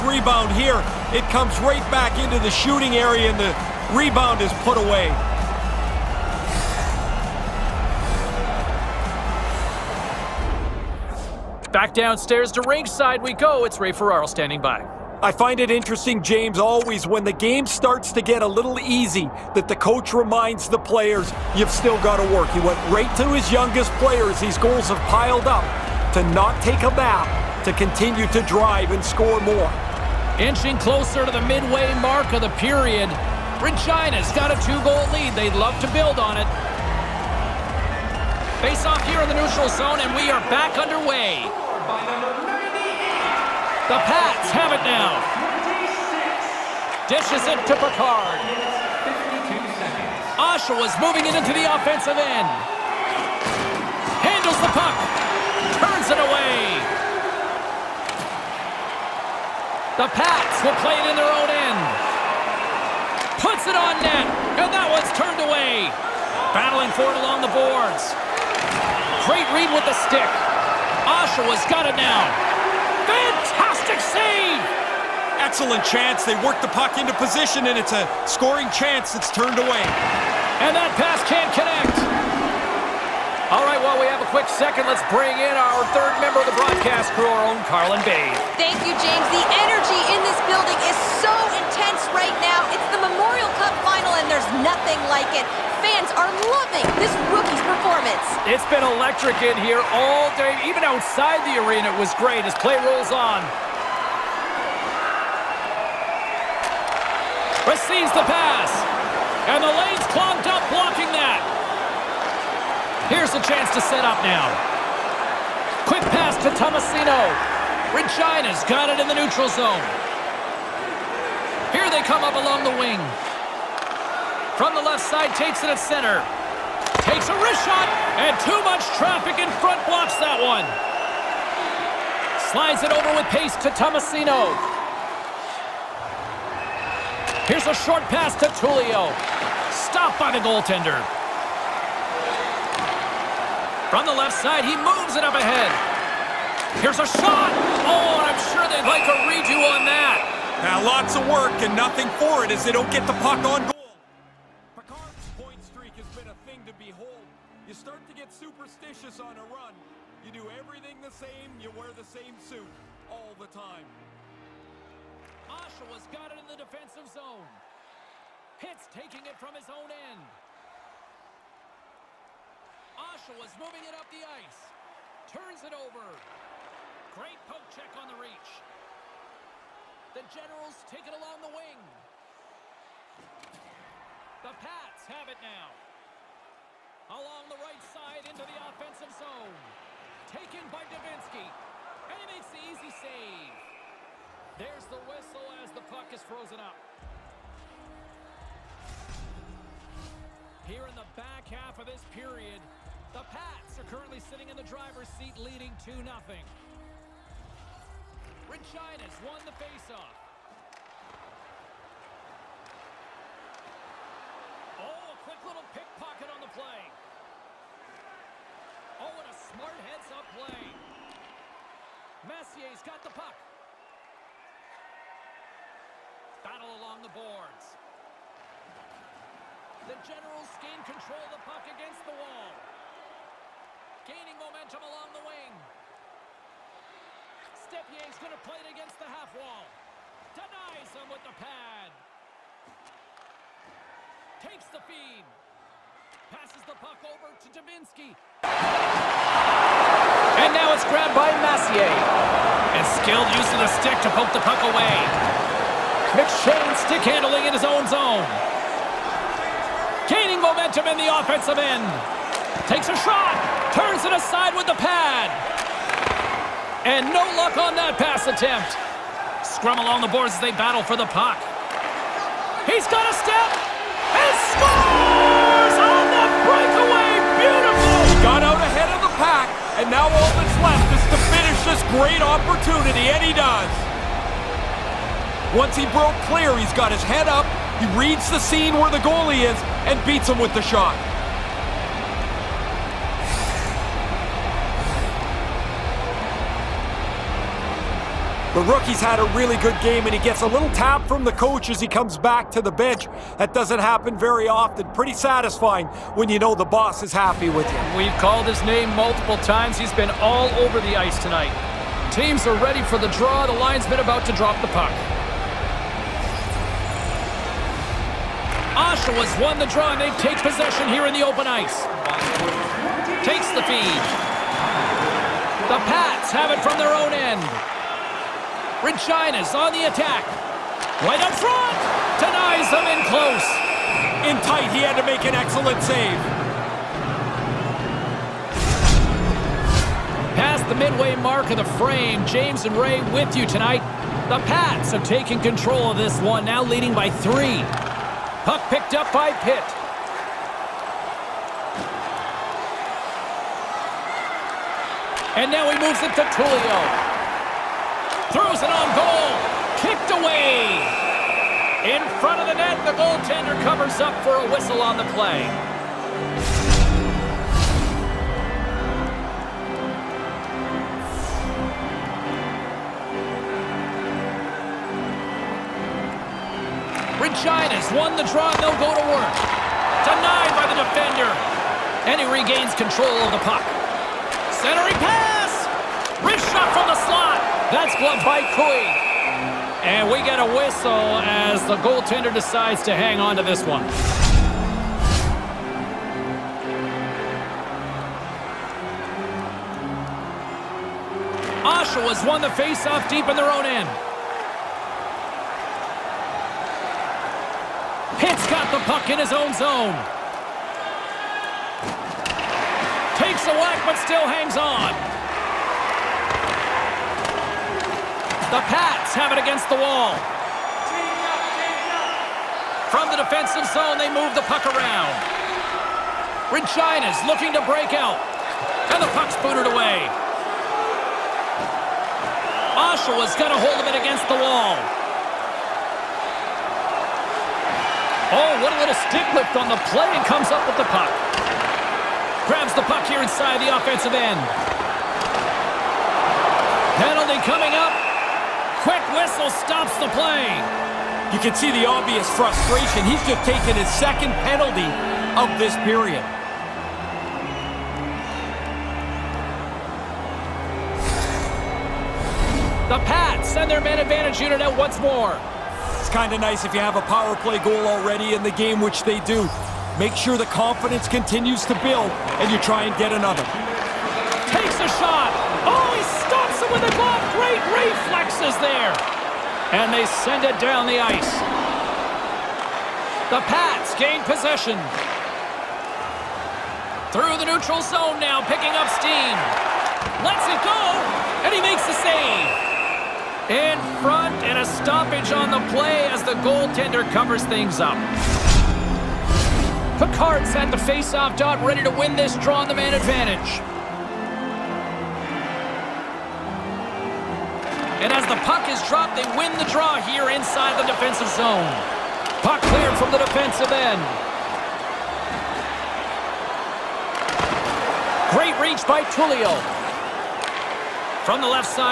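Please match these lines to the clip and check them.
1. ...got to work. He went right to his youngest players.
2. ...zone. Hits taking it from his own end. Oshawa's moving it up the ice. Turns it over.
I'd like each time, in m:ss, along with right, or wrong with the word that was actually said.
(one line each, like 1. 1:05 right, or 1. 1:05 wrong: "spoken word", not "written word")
1. 0:22 right
2. 2:47 right.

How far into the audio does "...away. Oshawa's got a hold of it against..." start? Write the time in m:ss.
7:09.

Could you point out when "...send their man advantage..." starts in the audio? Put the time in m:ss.
7:43.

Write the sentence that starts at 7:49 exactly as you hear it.
Make sure the confidence continues to build, and you try and get another.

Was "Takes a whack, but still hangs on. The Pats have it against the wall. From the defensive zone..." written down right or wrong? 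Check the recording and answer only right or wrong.
right.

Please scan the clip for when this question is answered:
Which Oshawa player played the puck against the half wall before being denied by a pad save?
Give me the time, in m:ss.
3:57.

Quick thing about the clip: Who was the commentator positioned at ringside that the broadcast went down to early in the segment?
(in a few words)
Ray Ferraro.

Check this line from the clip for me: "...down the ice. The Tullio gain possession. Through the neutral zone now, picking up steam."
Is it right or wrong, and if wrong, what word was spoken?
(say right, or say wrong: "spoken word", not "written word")
wrong: "Pats", not "Tullio".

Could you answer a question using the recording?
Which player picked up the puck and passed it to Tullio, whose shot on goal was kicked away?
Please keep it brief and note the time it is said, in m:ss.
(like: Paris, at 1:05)
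Pitt, at 5:49.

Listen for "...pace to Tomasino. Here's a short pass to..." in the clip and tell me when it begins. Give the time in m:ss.
2:13.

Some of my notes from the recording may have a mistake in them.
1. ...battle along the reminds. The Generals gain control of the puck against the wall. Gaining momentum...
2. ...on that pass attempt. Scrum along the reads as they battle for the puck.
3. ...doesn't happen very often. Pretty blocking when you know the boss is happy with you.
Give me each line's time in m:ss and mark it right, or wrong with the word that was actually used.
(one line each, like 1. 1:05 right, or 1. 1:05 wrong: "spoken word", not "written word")
1. 3:46 wrong: "boards", not "reminds"
2. 4:27 wrong: "boards", not "reads"
3. 5:03 wrong: "satisfying", not "blocking".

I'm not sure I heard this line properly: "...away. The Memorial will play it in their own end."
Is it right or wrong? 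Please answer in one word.
wrong.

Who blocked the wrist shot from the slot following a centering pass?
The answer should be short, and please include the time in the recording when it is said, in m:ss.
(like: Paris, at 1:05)
Cui, at 6:28.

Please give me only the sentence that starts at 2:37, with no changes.
You start to get superstitious on a run.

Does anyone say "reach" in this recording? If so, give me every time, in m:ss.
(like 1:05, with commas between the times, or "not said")
2:58, 8:38.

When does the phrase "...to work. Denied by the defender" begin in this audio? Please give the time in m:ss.
6:18.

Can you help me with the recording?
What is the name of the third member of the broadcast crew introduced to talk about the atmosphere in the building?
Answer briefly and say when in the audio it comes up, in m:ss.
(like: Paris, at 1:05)
Carlin Bay, at 1:27.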